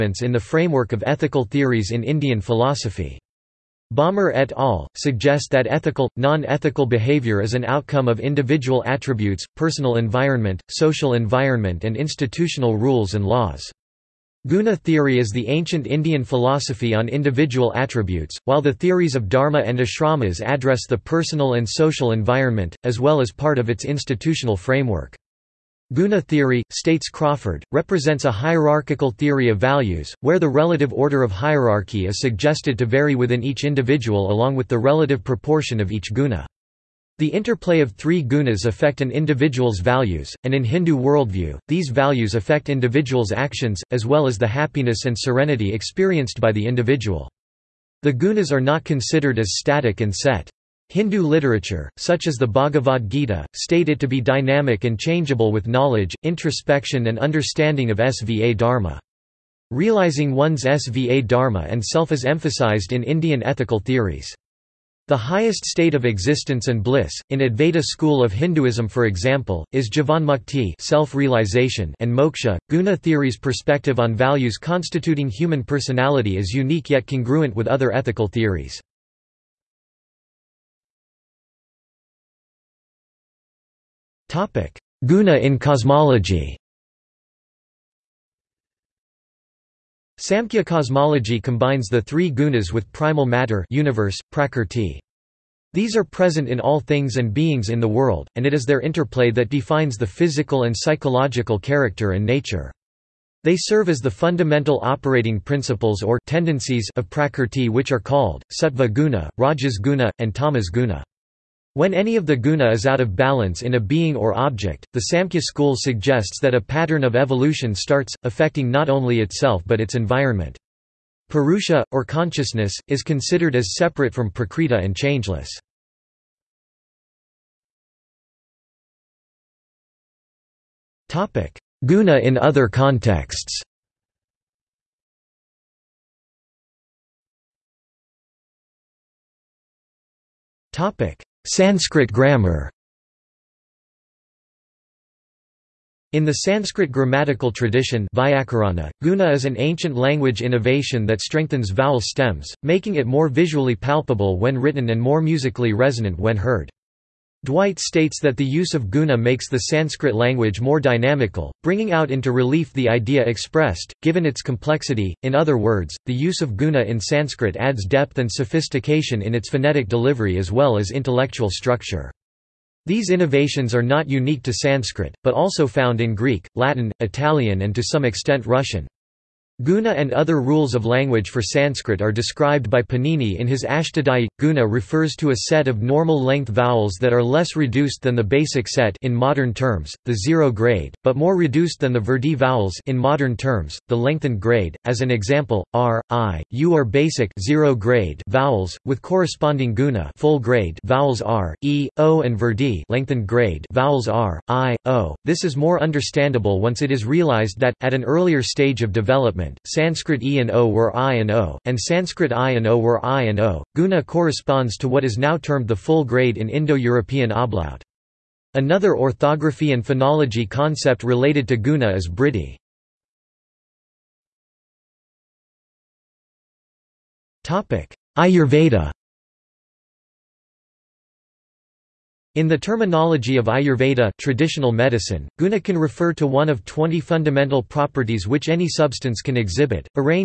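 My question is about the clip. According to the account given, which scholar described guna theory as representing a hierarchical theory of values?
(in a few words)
Crawford.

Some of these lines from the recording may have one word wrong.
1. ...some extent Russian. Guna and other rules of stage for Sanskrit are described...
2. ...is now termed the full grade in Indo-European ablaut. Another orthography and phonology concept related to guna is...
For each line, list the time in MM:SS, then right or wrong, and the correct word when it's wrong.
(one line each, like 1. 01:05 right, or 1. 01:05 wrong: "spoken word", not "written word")
1. 02:57 wrong: "language", not "stage"
2. 03:35 right.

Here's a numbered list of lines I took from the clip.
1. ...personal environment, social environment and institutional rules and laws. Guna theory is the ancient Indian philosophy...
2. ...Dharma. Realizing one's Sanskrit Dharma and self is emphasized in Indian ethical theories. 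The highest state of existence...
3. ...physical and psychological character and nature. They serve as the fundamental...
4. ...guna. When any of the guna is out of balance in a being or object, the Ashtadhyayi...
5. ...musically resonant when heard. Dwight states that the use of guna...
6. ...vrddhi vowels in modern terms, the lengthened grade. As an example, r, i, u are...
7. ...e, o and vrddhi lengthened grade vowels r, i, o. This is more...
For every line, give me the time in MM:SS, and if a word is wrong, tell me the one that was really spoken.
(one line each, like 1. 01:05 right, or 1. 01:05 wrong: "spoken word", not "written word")
1. 00:09 right
2. 00:58 wrong: "SVA", not "Sanskrit"
3. 01:40 right
4. 01:50 wrong: "Samkhya", not "Ashtadhyayi"
5. 02:35 right
6. 03:11 right
7. 03:21 right.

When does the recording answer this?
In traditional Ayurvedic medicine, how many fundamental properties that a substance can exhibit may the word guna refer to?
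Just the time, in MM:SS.
03:56.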